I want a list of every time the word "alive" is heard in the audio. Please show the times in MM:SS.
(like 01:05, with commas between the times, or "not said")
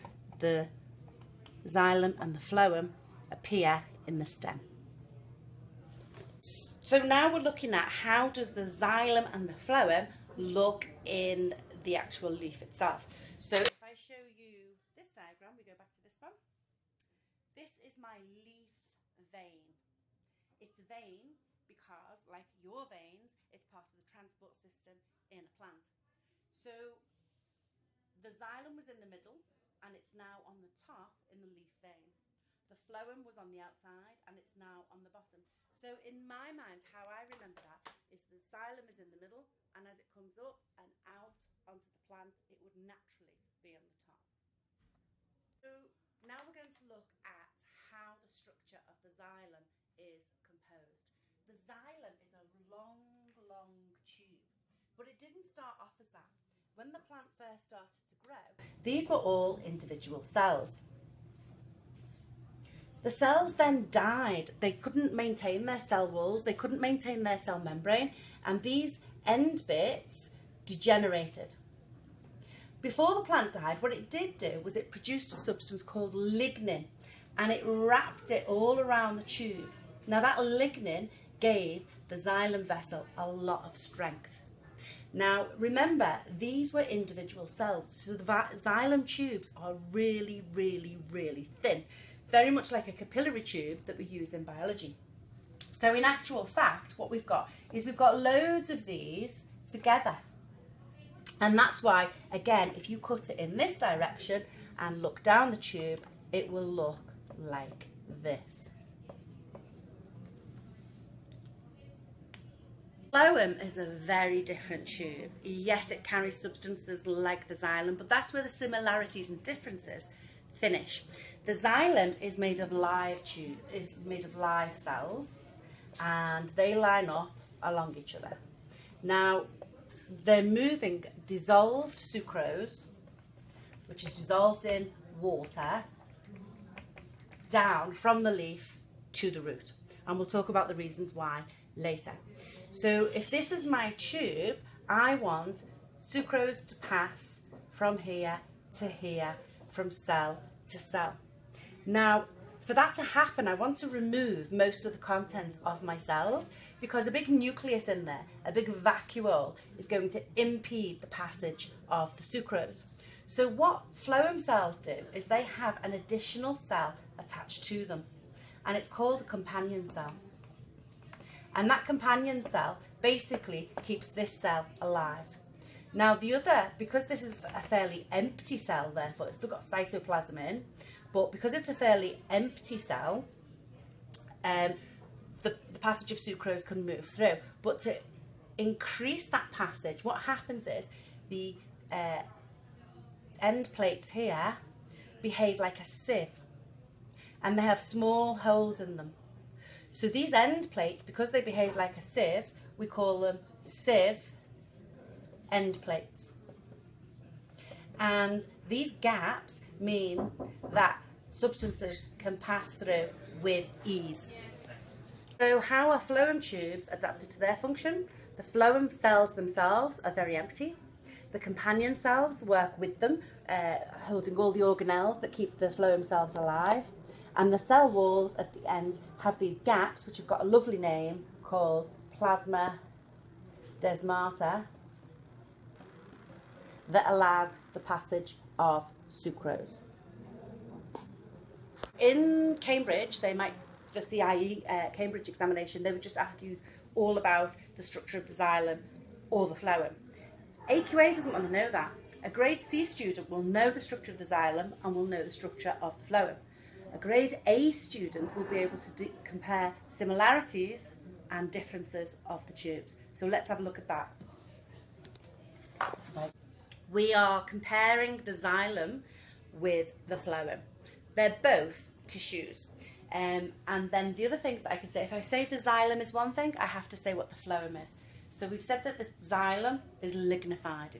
02:54, 03:46.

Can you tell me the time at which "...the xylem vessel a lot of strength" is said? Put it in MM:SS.
01:22.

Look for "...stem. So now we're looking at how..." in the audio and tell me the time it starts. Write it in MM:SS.
00:04.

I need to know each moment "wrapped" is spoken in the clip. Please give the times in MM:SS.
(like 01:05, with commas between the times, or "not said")
01:17.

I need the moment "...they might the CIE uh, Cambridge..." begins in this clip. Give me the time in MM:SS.
04:03.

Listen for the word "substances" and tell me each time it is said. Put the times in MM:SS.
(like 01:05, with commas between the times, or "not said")
01:15, 01:56, 03:31.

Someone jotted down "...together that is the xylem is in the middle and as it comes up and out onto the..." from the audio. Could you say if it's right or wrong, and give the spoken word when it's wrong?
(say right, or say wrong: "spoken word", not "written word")
wrong: "remember", not "together".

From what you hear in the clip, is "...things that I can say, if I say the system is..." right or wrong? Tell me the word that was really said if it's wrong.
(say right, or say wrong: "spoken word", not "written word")
wrong: "xylem", not "system".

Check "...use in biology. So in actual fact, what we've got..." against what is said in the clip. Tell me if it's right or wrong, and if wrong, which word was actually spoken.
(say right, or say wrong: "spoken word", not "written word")
right.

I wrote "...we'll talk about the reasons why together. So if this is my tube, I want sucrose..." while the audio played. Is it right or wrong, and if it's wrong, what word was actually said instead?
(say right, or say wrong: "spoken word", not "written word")
wrong: "later", not "together".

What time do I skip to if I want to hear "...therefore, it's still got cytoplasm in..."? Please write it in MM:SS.
02:58.